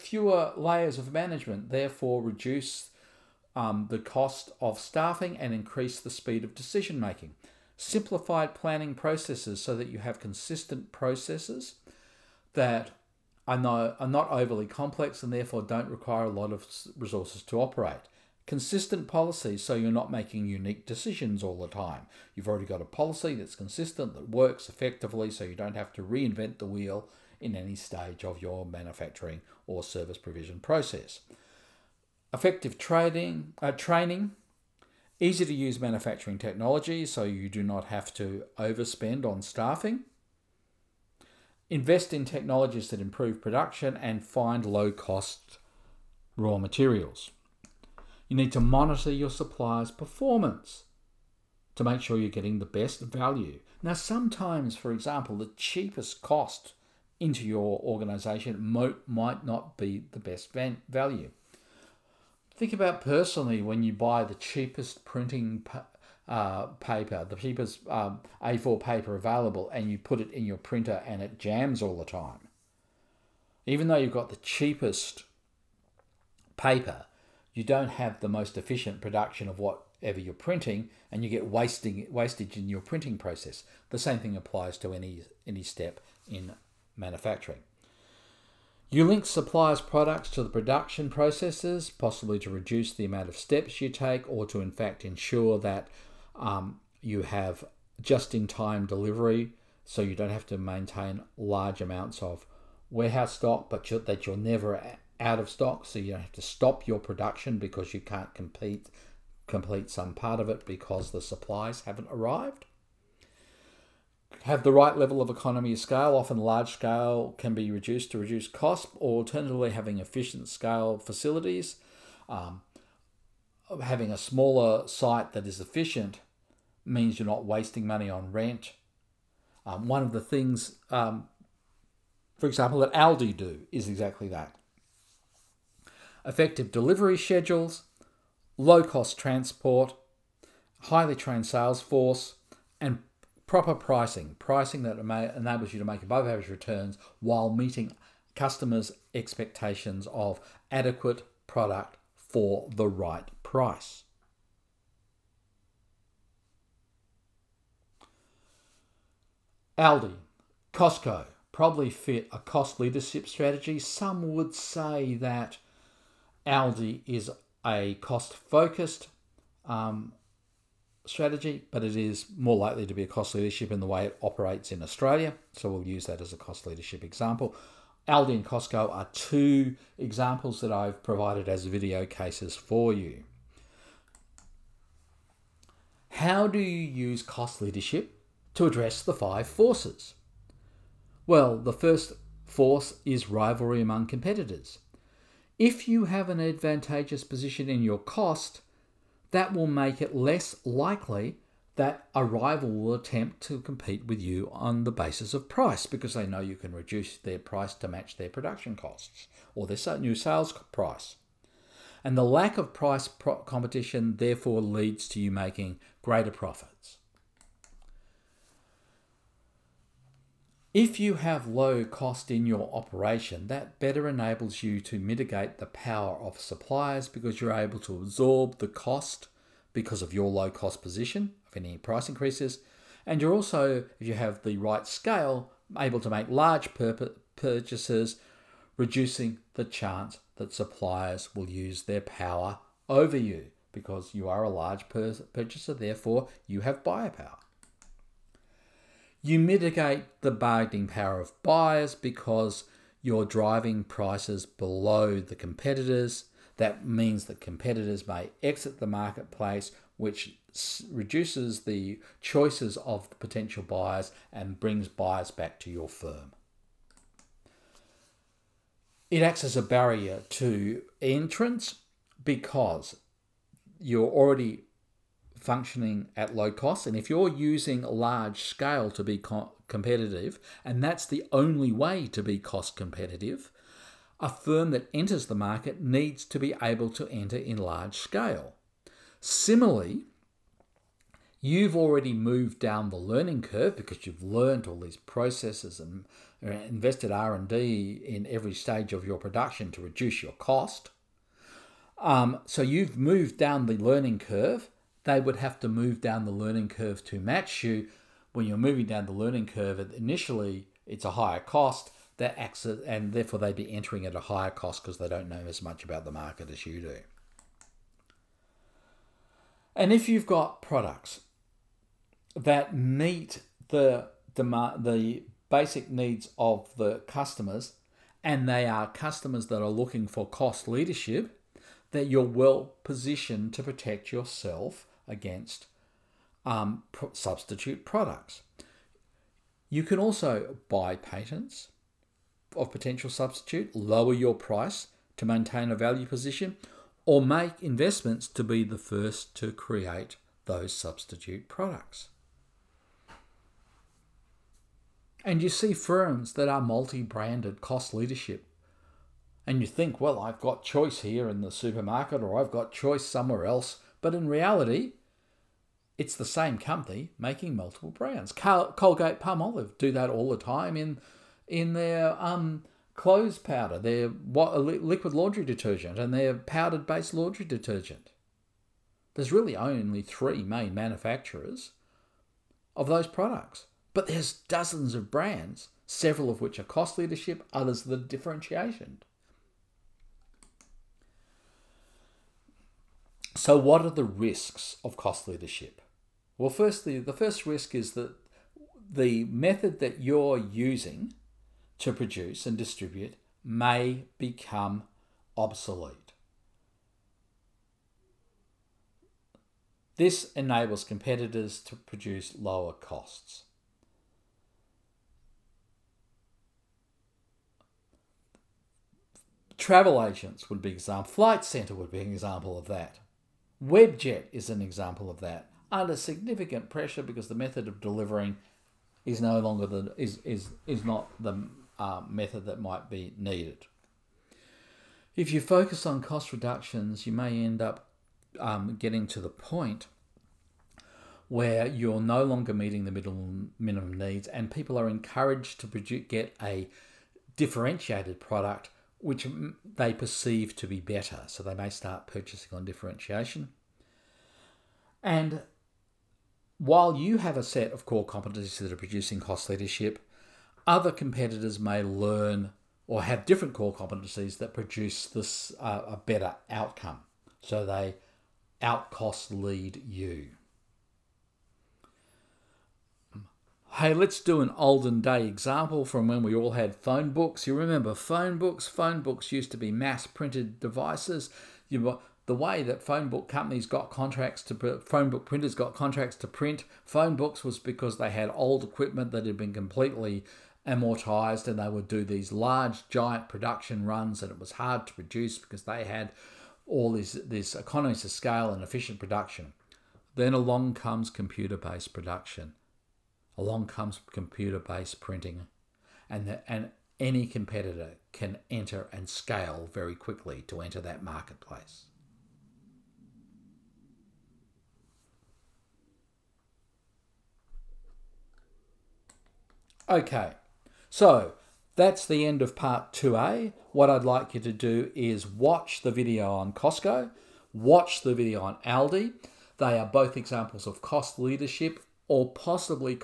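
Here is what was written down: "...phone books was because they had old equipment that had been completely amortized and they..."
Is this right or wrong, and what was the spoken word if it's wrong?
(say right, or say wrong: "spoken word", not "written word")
right.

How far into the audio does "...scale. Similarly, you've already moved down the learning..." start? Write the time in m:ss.
4:47.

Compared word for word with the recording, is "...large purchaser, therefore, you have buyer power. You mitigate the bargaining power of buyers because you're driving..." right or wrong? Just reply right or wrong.
right.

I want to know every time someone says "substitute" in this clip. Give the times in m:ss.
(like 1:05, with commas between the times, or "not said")
5:37, 5:43, 5:50.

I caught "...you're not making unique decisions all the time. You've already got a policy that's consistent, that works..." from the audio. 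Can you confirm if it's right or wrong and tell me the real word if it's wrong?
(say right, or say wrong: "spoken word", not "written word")
right.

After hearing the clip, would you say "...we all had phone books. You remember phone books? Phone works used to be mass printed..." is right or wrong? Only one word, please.
wrong.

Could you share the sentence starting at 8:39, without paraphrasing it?
Okay, so that's the end of part 2A.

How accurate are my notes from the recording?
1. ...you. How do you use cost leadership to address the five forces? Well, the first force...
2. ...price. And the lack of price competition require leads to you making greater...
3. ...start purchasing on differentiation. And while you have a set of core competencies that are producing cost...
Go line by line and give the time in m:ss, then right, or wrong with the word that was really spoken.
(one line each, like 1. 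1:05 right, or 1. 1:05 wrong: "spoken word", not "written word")
1. 3:02 right
2. 3:30 wrong: "therefore", not "require"
3. 7:31 right.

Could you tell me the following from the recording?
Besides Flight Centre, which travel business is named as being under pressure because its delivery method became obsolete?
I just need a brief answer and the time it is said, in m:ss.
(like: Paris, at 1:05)
Webjet, at 7:03.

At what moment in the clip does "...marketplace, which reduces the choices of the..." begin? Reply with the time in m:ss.
4:18.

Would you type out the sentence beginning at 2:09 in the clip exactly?
Um, one of the things, um, for example, that Aldi do is exactly that.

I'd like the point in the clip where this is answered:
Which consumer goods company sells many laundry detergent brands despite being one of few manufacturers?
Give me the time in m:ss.
6:08.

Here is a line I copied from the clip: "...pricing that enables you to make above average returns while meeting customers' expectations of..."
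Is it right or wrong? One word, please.
right.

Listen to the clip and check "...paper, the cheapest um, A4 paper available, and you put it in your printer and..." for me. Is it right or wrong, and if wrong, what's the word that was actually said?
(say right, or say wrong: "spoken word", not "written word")
right.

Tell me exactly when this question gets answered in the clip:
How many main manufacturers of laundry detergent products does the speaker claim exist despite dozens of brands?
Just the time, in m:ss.
6:20.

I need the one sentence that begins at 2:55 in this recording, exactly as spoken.
So we'll use that as a cost leadership example.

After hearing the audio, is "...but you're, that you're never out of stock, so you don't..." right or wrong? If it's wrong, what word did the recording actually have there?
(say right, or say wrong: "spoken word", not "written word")
right.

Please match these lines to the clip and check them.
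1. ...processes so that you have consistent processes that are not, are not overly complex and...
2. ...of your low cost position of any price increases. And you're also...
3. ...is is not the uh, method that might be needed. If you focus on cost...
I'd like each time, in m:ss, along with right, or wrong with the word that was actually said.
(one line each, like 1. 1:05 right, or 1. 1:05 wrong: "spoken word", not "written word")
1. 0:08 right
2. 3:50 right
3. 7:10 right.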